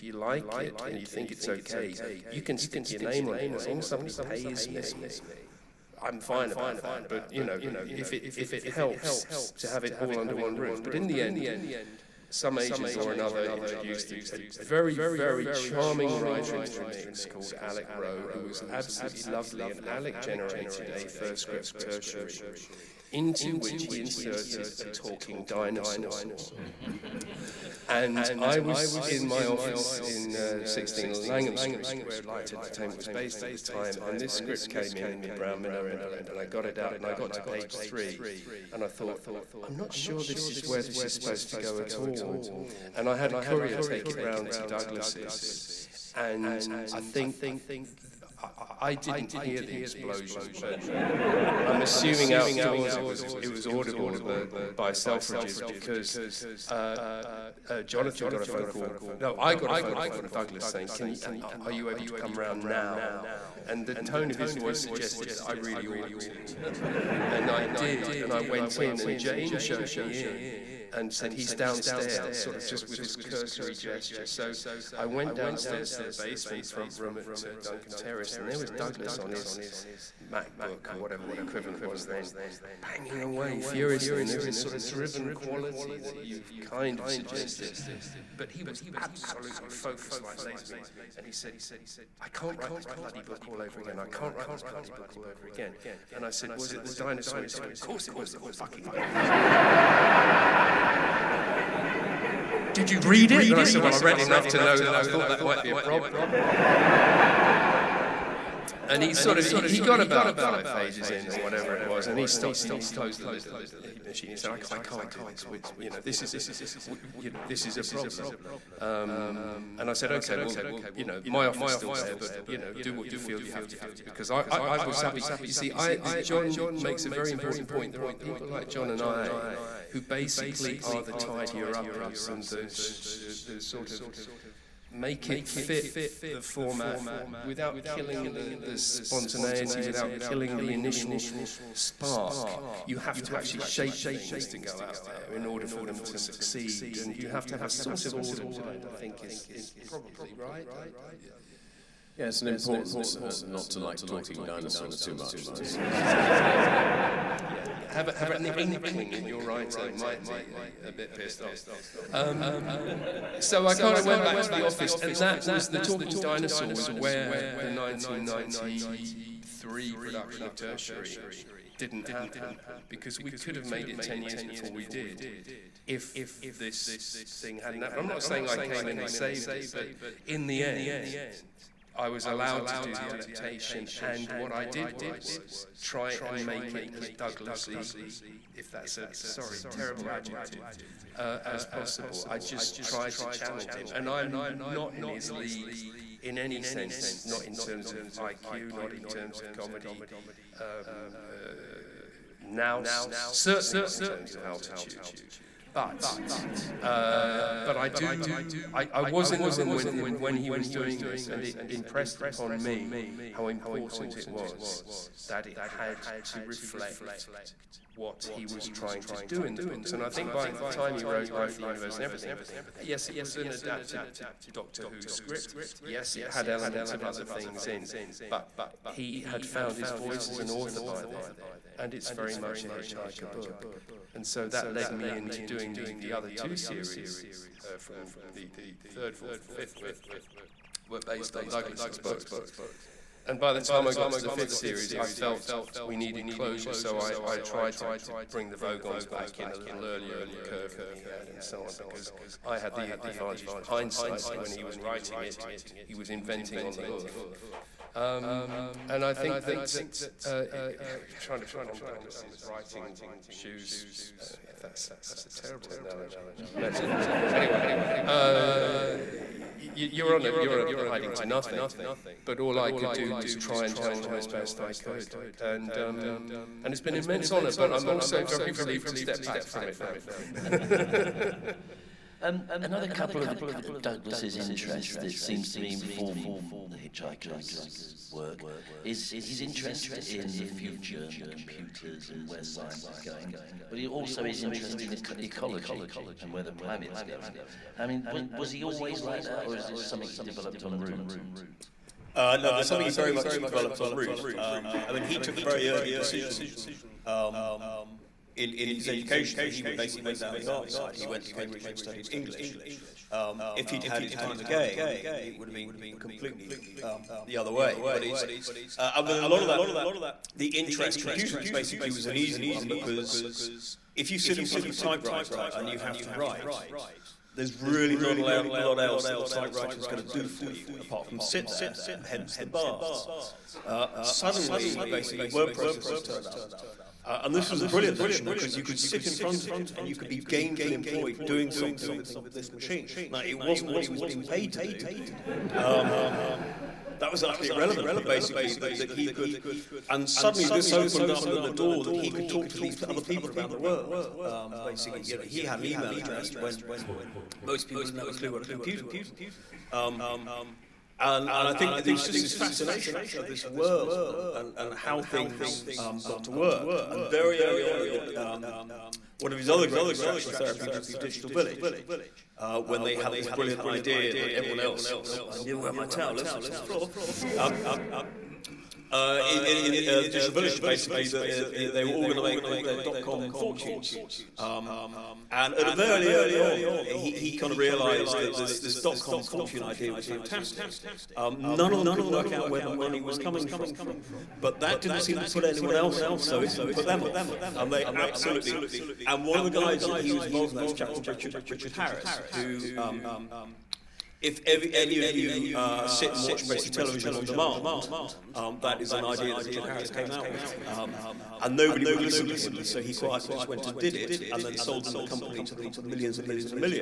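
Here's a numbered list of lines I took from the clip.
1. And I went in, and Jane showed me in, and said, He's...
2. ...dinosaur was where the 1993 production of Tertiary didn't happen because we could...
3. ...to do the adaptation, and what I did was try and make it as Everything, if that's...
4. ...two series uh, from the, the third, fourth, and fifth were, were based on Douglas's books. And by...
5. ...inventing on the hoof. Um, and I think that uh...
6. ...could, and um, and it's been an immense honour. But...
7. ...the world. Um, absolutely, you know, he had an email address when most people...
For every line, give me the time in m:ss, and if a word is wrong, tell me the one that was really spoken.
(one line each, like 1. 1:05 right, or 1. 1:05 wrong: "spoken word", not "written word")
1. 1:08 right
2. 2:46 right
3. 3:02 wrong: "Douglasy", not "Everything"
4. 3:56 right
5. 4:16 right
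6. 4:34 right
7. 5:53 wrong: "basically", not "absolutely".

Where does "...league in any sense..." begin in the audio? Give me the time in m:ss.
3:15.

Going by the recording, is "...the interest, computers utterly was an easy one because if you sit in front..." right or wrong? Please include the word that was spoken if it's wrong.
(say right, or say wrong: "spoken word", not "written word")
wrong: "basically", not "utterly".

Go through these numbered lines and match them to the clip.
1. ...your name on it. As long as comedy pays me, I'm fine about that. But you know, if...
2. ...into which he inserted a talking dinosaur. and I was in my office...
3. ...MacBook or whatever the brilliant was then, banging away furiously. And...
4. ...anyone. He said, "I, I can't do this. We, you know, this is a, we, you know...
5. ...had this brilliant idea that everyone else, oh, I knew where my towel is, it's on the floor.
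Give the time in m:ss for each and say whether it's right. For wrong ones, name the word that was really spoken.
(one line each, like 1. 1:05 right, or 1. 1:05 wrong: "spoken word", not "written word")
1. 0:02 wrong: "somebody", not "comedy"
2. 0:23 right
3. 1:20 wrong: "equivalent", not "brilliant"
4. 1:54 wrong: "machine", not "anyone"
5. 6:12 right.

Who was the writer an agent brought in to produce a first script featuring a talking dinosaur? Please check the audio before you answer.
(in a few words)
Alec Rowe.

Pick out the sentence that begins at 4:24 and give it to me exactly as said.
Uh, if that's that's a terrible analogy.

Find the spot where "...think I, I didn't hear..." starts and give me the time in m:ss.
0:46.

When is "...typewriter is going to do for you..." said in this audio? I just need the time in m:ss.
5:29.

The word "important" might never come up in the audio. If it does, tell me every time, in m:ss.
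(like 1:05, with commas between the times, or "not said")
2:07, 2:32, 3:33.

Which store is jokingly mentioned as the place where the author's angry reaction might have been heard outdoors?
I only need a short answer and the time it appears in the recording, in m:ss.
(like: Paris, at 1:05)
Selfridges, at 0:54.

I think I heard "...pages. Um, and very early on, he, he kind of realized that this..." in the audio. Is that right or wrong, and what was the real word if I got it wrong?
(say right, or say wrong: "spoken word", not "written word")
wrong: "fortunes", not "pages".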